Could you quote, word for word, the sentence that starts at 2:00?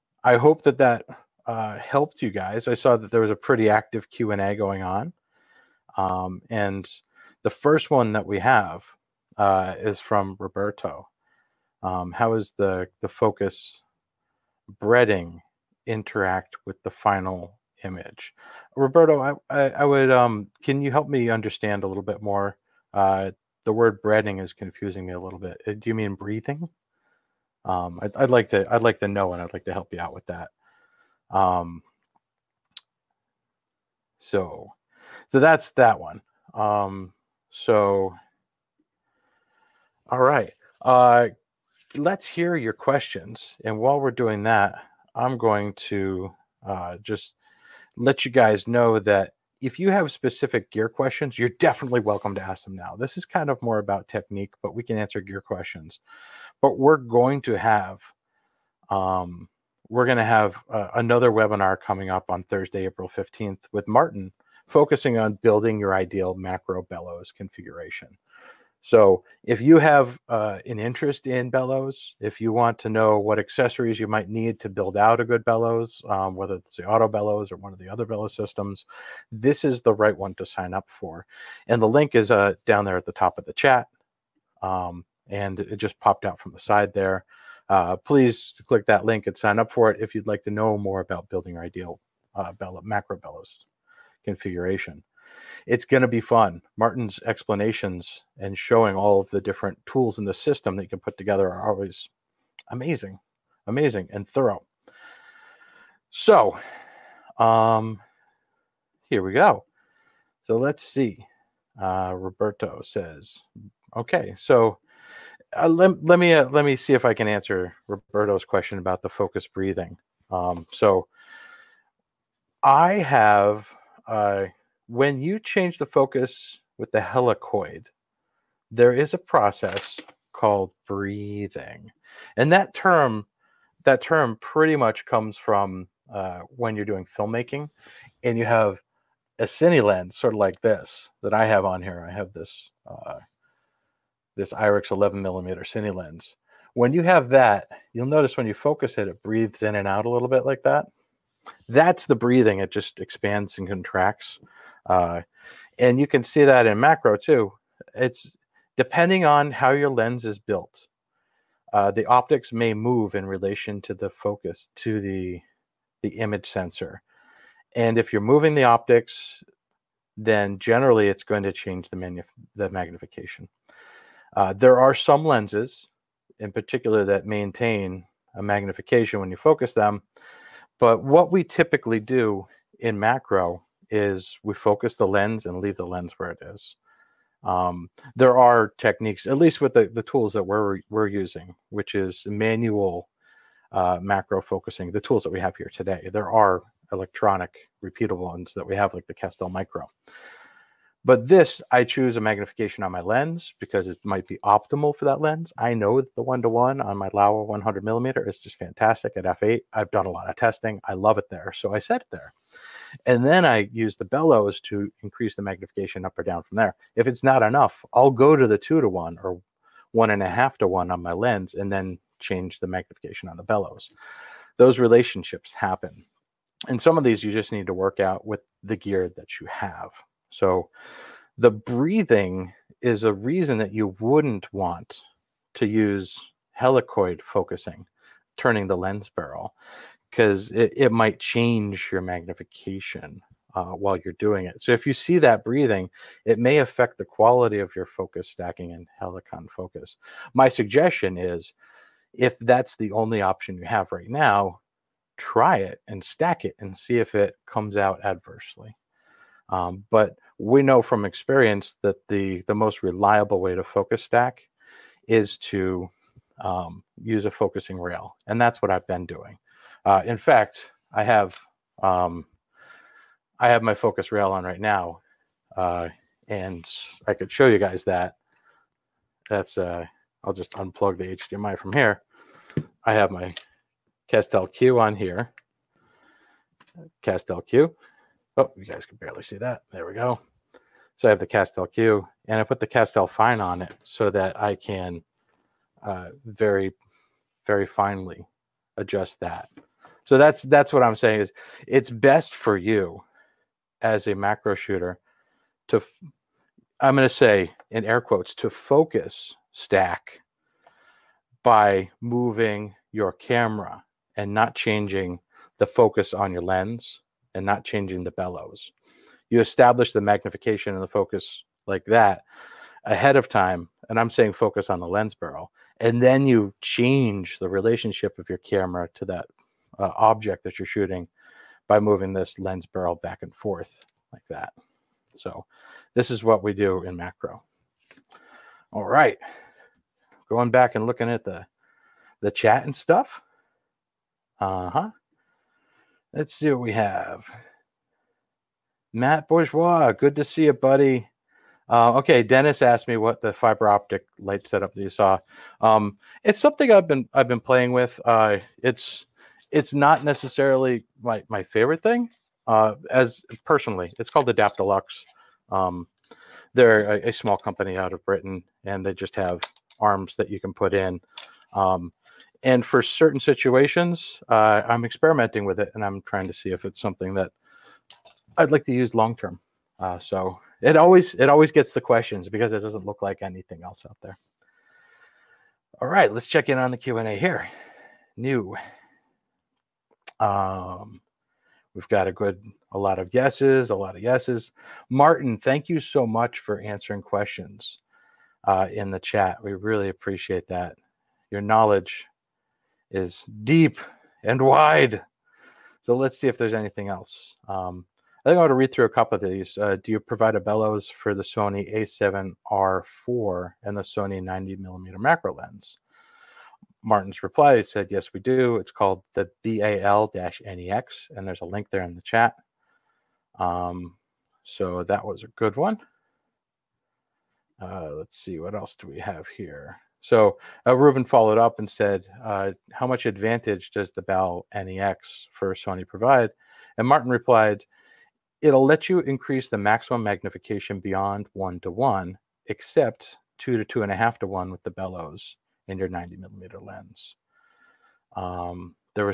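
Um, so I have a when you change the focus with the helicoid, there is a process called breathing.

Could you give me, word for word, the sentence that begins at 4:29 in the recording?
Uh, in fact, I have um, I have my Focus Rail on right now, uh, and I could show you guys that.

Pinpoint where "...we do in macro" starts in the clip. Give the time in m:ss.
5:36.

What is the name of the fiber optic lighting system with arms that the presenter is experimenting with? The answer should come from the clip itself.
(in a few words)
Adaptalux.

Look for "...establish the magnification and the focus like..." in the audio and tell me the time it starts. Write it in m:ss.
5:19.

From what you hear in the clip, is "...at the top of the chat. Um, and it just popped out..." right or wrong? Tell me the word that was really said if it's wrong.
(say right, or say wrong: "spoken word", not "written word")
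right.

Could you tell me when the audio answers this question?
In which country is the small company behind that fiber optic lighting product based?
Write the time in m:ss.
6:08.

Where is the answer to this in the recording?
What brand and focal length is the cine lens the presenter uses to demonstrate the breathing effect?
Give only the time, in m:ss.
2:24.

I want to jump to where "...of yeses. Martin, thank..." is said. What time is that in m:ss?
6:33.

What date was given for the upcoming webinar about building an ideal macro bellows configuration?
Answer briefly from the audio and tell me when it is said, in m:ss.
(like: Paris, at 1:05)
Thursday, April 15th, at 1:02.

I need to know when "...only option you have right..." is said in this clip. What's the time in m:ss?
4:12.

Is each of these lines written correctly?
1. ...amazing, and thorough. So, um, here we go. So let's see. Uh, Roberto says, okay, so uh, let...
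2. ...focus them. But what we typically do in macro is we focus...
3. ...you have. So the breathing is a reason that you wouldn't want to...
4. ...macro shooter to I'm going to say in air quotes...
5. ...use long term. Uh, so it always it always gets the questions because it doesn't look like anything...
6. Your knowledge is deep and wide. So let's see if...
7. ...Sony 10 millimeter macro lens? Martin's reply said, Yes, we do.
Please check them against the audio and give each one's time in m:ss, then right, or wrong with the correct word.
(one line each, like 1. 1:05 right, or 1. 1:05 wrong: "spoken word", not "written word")
1. 1:43 right
2. 2:59 right
3. 3:49 right
4. 5:04 right
5. 6:18 right
6. 6:41 right
7. 6:53 wrong: "90", not "10".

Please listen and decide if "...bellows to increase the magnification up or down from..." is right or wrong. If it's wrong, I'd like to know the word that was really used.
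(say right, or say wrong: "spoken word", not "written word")
right.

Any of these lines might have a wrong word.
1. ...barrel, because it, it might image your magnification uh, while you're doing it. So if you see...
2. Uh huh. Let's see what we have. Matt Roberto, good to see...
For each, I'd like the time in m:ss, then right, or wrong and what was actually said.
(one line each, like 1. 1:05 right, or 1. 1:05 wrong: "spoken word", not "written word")
1. 3:59 wrong: "change", not "image"
2. 5:44 wrong: "Bourgeois", not "Roberto".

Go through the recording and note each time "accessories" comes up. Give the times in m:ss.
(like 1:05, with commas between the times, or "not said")
1:13.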